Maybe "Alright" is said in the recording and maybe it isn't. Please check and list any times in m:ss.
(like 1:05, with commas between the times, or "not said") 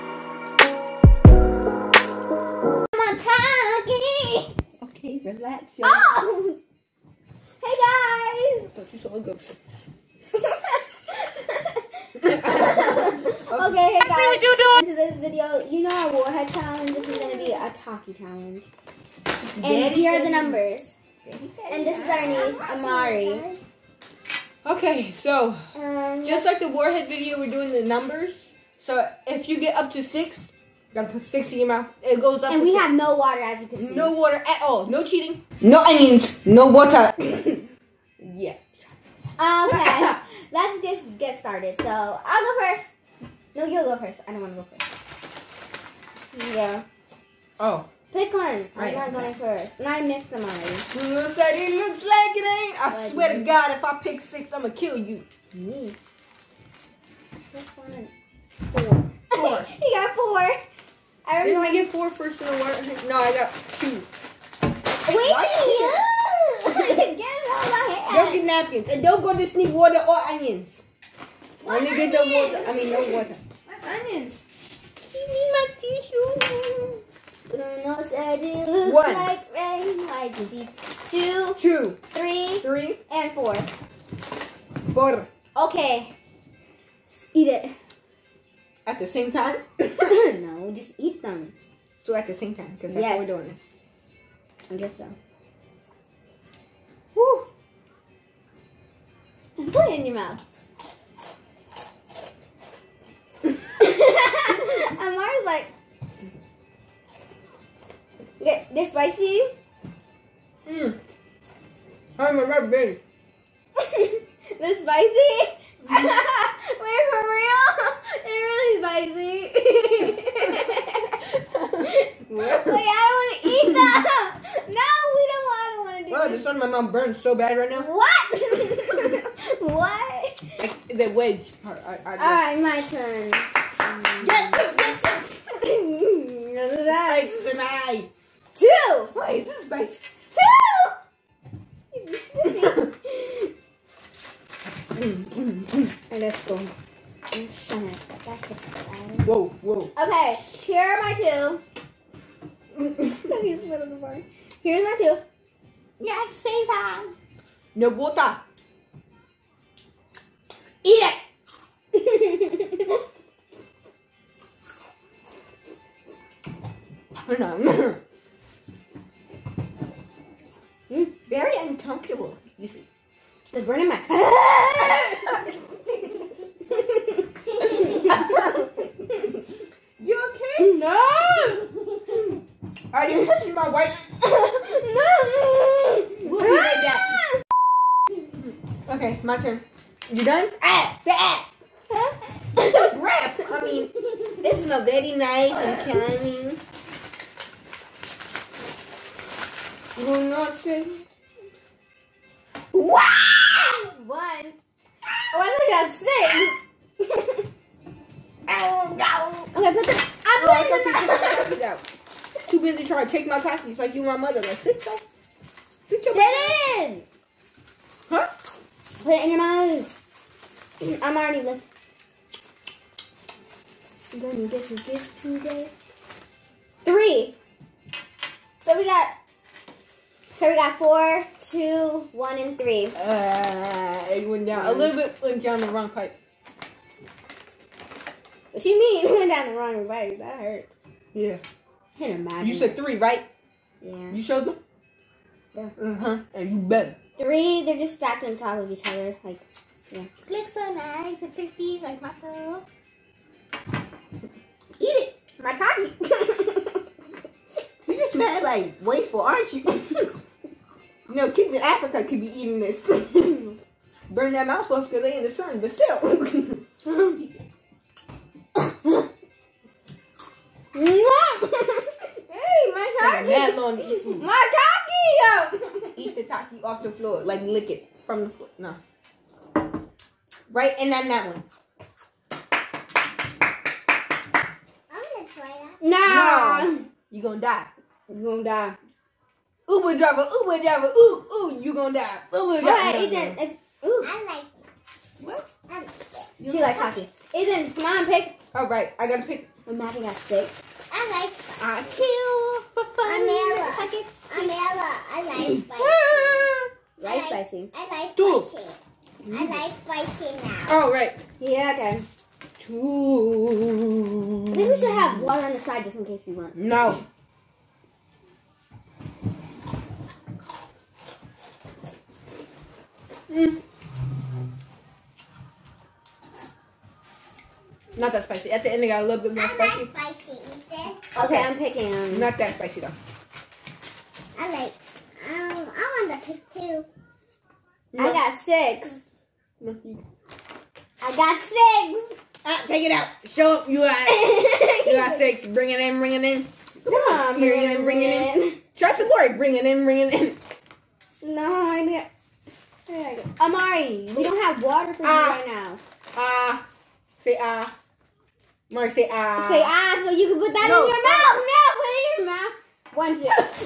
2:12, 4:52, 4:58.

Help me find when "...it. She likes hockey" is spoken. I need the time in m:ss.
4:55.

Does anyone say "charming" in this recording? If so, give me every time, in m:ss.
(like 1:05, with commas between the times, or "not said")
3:15.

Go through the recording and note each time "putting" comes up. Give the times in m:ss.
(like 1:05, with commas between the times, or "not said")
3:31.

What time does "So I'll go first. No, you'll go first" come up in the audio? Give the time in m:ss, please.
0:41.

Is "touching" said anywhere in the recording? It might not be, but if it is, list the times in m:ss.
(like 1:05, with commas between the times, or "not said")
3:03.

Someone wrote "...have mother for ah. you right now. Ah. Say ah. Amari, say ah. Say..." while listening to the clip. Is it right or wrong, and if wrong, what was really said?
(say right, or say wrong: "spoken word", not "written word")
wrong: "water", not "mother".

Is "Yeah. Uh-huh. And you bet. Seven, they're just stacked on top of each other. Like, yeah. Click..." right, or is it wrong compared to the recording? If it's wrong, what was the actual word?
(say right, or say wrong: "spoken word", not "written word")
wrong: "Three", not "Seven".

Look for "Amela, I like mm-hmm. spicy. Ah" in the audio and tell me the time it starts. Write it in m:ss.
5:04.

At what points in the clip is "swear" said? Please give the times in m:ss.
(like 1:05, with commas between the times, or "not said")
0:53.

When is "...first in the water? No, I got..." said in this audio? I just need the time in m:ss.
1:02.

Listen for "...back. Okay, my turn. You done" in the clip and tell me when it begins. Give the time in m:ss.
3:08.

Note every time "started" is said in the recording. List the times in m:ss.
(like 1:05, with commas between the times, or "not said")
0:41.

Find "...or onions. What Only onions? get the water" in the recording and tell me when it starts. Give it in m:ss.
1:10.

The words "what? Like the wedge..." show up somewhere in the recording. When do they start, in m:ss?
2:09.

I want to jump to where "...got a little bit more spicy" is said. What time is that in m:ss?
5:28.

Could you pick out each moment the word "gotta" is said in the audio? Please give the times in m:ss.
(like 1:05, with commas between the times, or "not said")
0:31, 4:59.